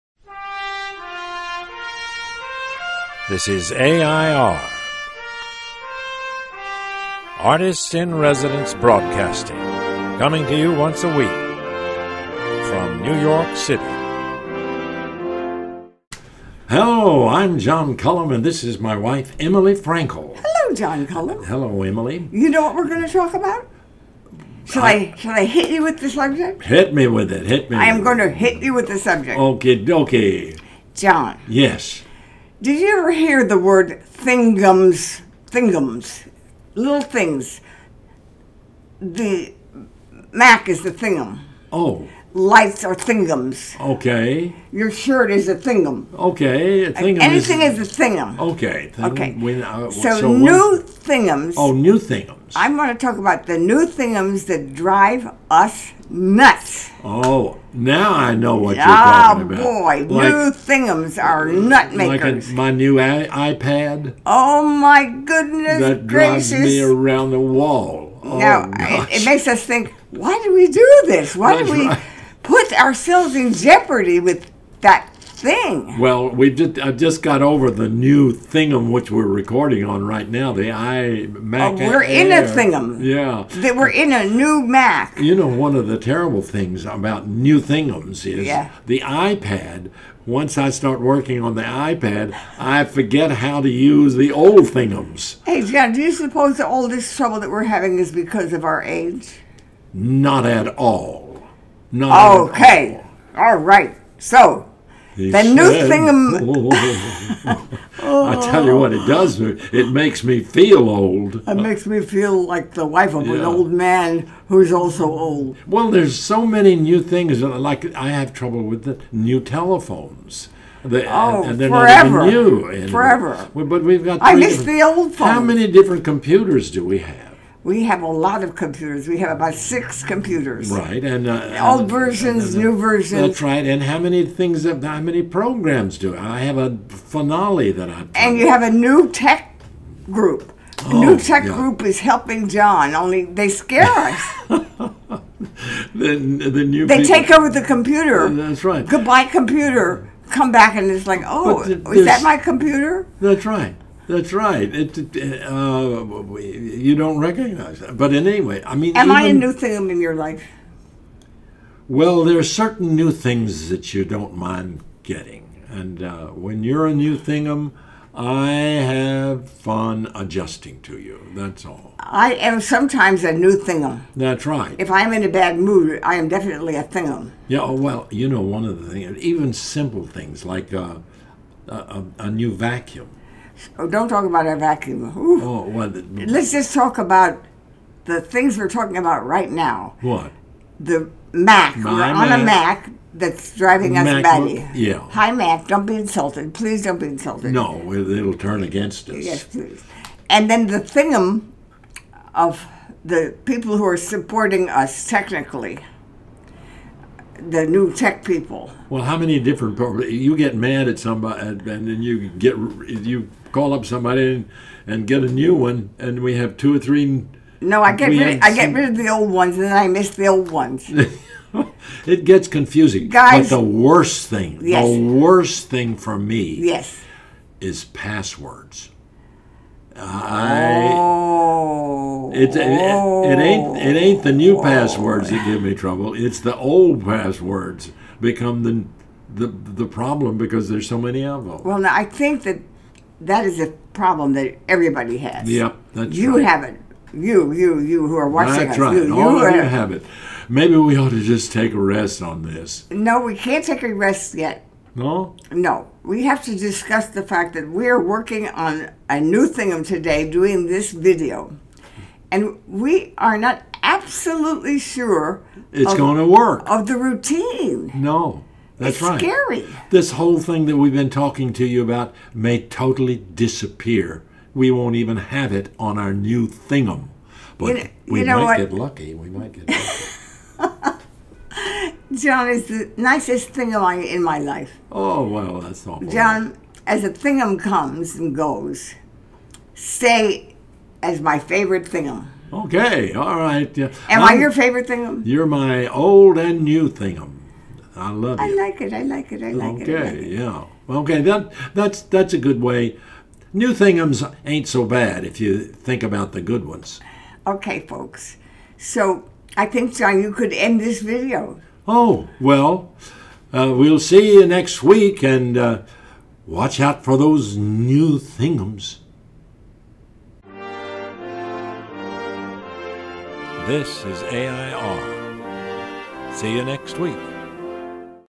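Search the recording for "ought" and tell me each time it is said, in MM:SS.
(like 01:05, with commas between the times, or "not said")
04:10.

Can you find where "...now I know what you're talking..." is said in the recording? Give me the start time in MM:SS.
00:57.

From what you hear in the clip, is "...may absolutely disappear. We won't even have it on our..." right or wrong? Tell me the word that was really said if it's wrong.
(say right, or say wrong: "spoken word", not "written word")
wrong: "totally", not "absolutely".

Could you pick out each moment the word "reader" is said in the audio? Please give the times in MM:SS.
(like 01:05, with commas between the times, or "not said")
not said.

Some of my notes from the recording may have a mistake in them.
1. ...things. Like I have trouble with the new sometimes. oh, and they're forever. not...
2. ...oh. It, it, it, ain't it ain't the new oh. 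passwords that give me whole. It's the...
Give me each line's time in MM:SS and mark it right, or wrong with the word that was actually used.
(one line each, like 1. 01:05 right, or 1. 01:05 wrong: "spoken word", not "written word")
1. 01:57 wrong: "telephones", not "sometimes"
2. 03:50 wrong: "trouble", not "whole".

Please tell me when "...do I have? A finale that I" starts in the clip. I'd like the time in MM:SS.
02:15.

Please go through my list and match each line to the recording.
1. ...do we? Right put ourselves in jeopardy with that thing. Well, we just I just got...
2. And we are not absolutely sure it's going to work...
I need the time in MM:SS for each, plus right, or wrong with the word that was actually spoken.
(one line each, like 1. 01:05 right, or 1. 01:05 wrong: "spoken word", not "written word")
1. 01:11 right
2. 04:22 right.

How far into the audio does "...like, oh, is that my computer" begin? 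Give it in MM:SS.
02:31.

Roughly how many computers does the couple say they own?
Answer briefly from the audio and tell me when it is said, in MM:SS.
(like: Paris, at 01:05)
6, at 02:09.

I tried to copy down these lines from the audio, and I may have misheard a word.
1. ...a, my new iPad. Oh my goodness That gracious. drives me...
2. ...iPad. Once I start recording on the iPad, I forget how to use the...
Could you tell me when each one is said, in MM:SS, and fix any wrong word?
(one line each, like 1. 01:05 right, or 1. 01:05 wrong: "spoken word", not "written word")
1. 01:02 right
2. 01:29 wrong: "working", not "recording".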